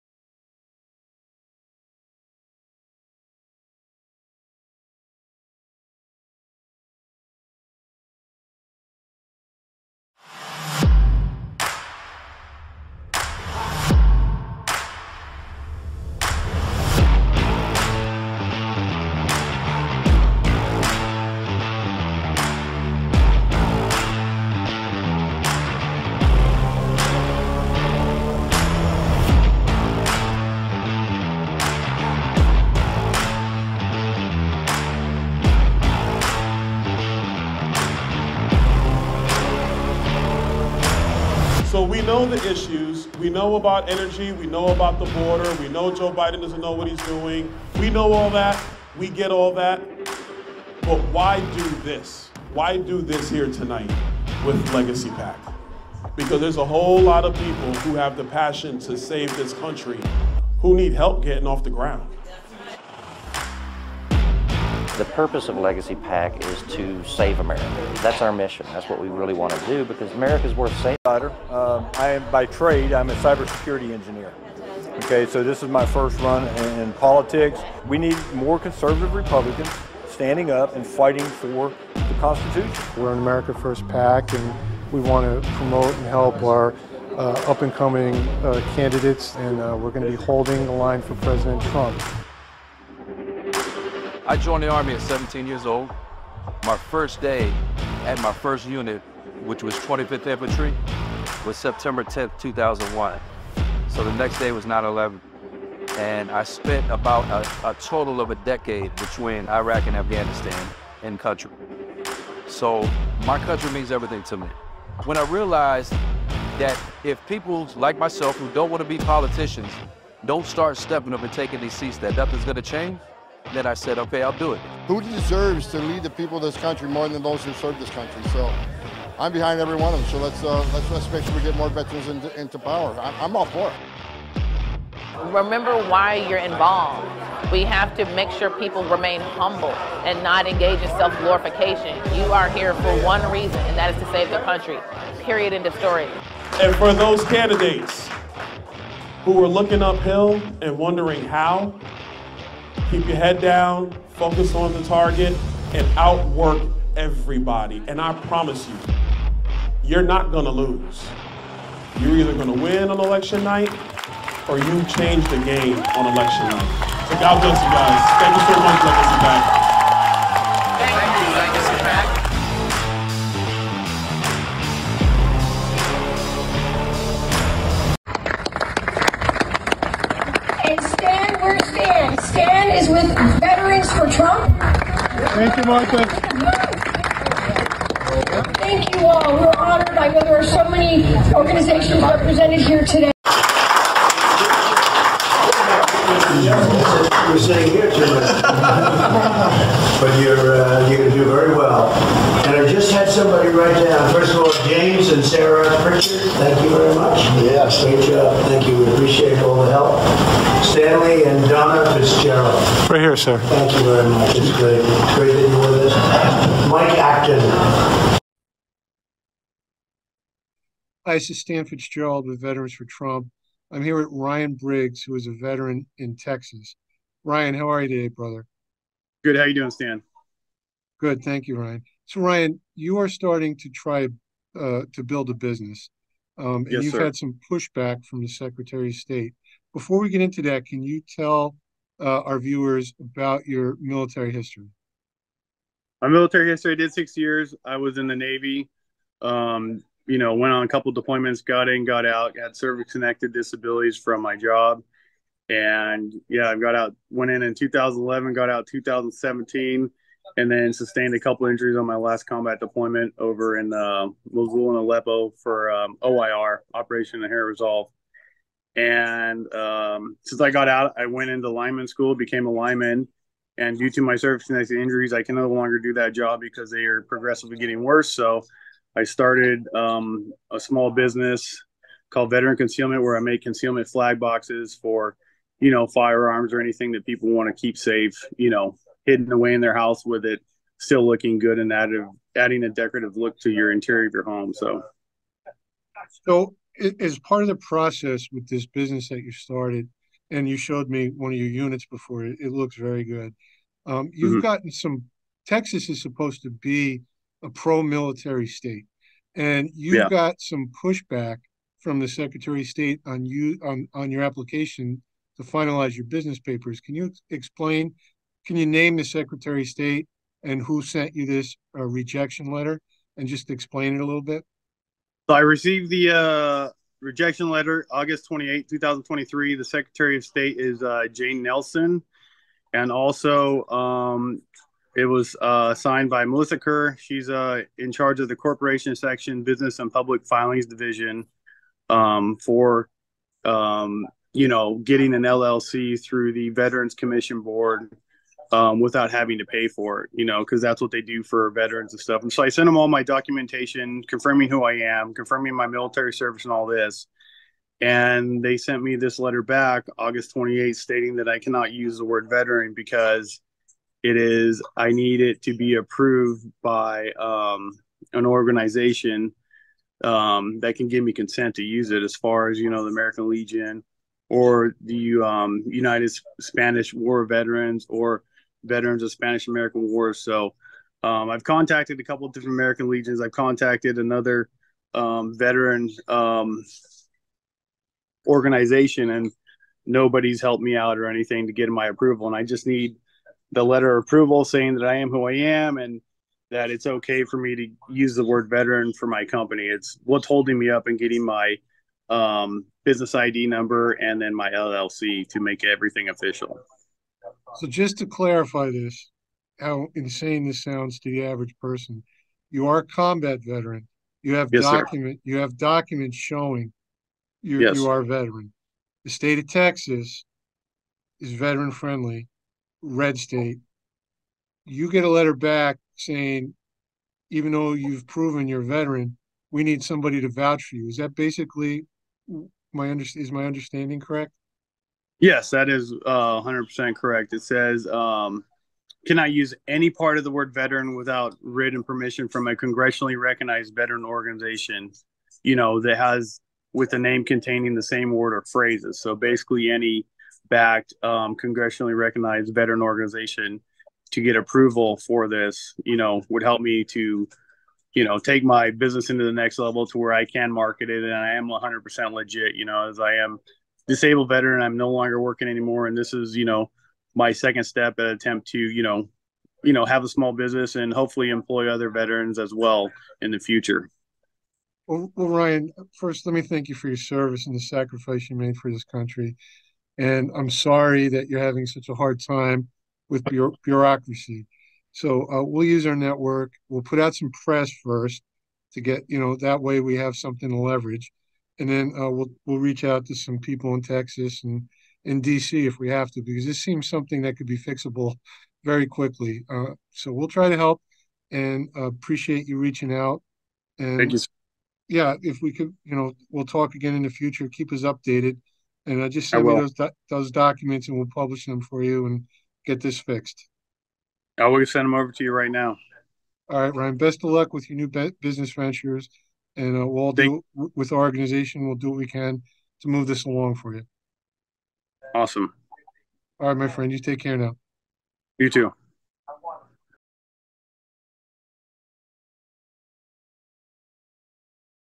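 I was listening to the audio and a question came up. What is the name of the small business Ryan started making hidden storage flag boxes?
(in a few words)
Veteran Concealment.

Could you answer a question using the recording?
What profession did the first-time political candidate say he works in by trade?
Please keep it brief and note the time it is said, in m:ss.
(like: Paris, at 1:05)
cybersecurity engineer, at 1:13.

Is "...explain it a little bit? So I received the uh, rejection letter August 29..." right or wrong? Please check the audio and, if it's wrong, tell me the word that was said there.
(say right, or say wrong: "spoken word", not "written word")
wrong: "28", not "29".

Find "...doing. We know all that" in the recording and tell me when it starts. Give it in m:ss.
0:47.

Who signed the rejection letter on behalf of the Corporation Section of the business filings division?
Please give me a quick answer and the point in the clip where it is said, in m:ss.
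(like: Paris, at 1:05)
Melissa Kerr, at 5:36.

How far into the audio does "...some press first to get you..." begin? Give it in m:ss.
8:07.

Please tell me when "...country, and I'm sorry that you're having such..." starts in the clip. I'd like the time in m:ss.
7:58.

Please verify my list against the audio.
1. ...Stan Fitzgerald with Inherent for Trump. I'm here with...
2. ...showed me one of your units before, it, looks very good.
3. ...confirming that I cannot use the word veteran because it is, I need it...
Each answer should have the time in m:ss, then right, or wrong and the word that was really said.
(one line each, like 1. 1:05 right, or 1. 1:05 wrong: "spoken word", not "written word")
1. 3:41 wrong: "Veterans", not "Inherent"
2. 5:00 right
3. 6:00 wrong: "stating", not "confirming".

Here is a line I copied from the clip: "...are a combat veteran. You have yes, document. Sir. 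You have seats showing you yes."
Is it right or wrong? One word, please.
wrong.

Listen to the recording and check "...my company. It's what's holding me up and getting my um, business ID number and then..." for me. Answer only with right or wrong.
right.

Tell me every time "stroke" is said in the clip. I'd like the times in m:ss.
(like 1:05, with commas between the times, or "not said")
not said.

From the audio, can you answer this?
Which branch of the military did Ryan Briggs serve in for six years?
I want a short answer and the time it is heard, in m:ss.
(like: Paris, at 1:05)
Navy, at 4:08.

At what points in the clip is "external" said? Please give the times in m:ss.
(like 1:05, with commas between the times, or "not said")
not said.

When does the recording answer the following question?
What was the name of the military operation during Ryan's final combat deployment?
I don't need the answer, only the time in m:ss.
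4:26.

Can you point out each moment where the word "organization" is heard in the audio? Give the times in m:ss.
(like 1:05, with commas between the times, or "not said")
3:11, 6:08, 6:28, 7:24, 7:32, 8:40.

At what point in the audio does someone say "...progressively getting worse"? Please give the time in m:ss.
4:37.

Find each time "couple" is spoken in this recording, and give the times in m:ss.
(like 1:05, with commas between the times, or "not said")
4:10, 4:21, 6:22.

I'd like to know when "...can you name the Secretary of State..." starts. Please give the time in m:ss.
5:18.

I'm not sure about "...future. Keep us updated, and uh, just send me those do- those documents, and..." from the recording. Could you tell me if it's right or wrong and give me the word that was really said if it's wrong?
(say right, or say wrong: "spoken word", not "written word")
right.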